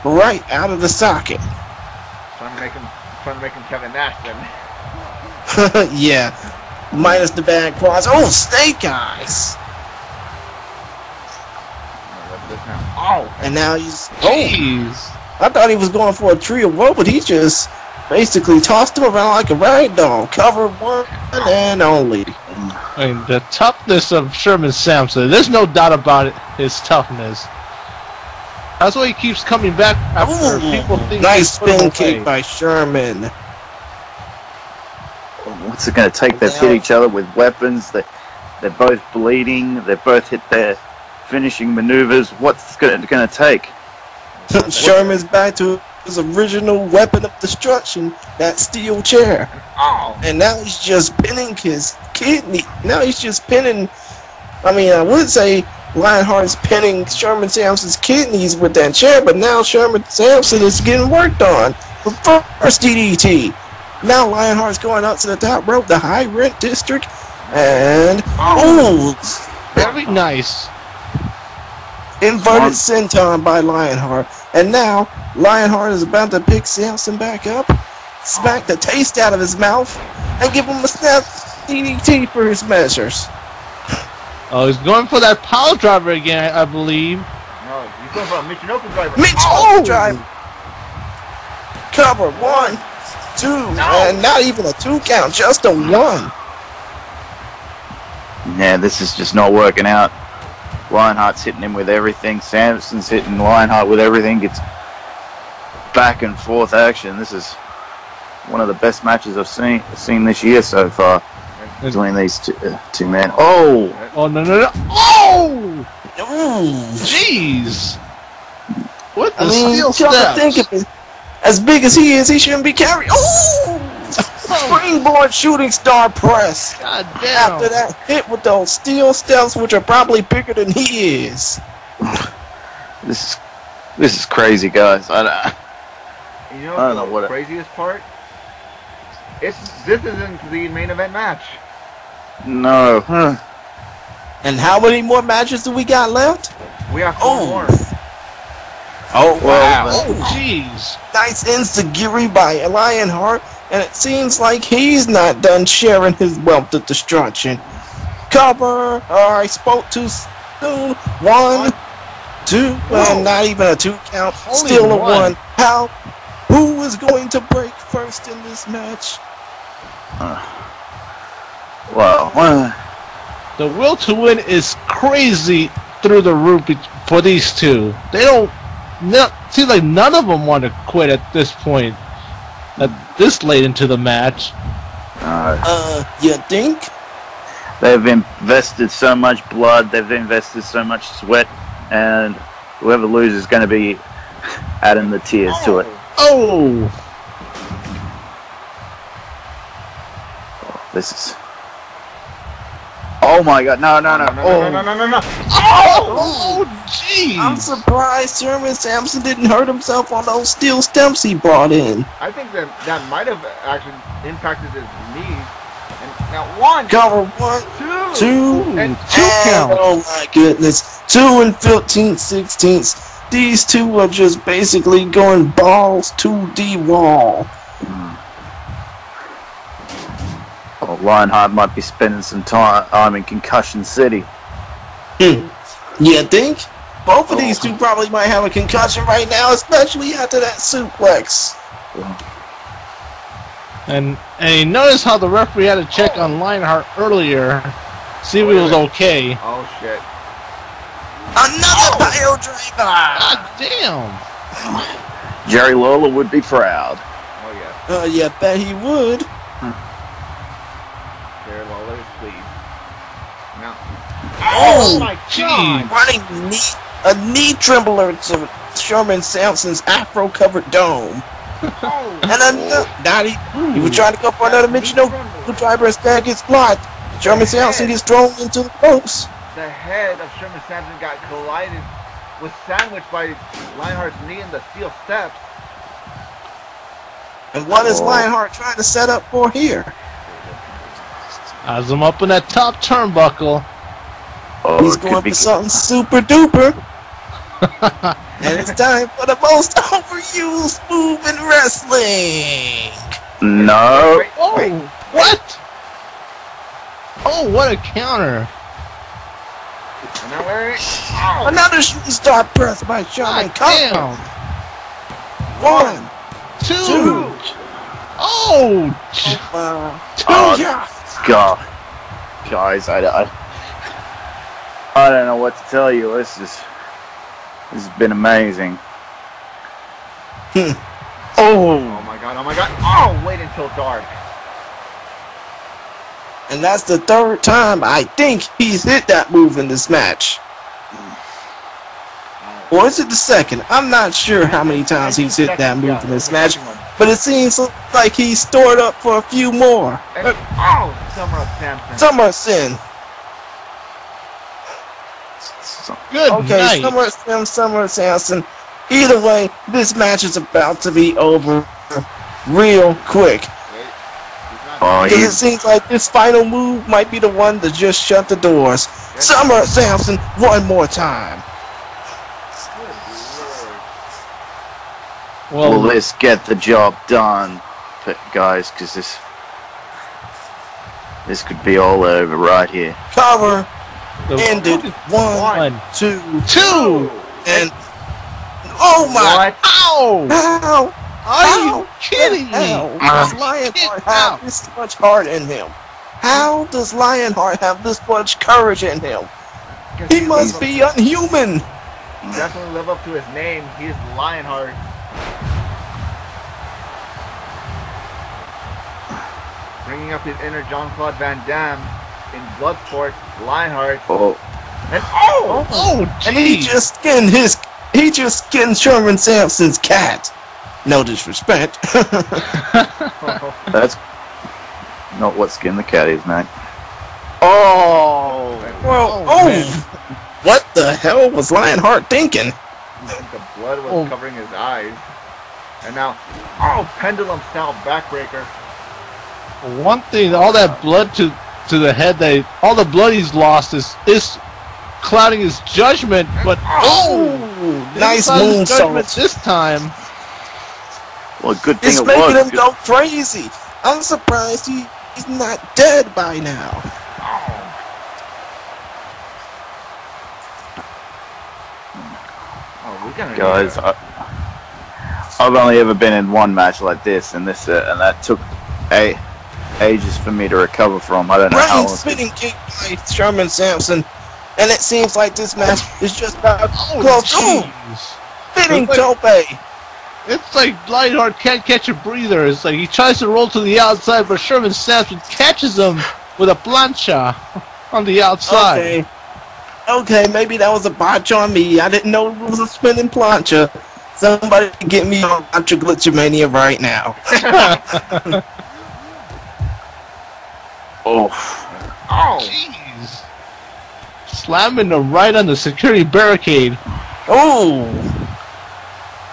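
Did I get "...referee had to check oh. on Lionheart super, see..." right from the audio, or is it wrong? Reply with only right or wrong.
wrong.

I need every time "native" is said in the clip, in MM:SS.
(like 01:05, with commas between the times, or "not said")
not said.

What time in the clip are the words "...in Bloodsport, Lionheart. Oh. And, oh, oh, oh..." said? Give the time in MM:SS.
06:52.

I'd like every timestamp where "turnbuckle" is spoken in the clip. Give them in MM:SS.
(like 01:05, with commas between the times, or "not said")
04:52.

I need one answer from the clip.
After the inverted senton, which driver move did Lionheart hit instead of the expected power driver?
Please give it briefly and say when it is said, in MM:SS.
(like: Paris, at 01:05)
Michinoku driver, at 01:28.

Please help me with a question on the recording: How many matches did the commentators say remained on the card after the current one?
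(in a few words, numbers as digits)
4.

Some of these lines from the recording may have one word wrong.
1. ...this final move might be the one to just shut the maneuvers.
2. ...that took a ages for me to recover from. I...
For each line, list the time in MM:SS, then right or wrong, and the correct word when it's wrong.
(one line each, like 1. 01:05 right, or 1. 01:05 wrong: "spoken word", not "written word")
1. 06:05 wrong: "doors", not "maneuvers"
2. 07:47 right.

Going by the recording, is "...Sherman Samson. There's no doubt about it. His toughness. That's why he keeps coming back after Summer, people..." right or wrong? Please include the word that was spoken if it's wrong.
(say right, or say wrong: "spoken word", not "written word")
wrong: "Ooh", not "Summer".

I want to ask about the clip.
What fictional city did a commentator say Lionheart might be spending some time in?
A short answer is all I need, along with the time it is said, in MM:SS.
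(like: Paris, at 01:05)
Concussion City, at 03:53.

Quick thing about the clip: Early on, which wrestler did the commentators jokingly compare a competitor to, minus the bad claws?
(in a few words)
Kevin Nash.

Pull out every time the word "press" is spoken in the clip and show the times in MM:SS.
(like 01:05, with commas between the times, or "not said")
02:06, 05:12.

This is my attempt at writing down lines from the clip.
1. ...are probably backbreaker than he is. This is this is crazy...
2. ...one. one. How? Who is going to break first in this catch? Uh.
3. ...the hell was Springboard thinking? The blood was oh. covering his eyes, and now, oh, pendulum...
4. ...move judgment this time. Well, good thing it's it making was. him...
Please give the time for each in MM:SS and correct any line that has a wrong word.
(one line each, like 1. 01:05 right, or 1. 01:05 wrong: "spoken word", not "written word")
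1. 02:09 wrong: "bigger", not "backbreaker"
2. 02:44 wrong: "match", not "catch"
3. 07:10 wrong: "Lionheart", not "Springboard"
4. 07:28 right.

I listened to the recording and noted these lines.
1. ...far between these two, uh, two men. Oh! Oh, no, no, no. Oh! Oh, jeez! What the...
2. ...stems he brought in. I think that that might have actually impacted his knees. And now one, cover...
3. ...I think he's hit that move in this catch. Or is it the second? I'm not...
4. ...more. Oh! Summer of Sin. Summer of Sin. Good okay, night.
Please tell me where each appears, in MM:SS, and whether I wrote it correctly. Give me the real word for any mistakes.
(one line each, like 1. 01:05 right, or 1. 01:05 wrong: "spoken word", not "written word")
1. 01:50 right
2. 03:30 right
3. 05:37 wrong: "match", not "catch"
4. 05:49 right.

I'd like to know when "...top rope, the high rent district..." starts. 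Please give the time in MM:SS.
01:05.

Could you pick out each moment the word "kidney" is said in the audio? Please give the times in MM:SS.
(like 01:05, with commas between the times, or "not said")
00:52, 00:57.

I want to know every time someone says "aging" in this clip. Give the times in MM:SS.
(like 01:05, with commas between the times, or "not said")
not said.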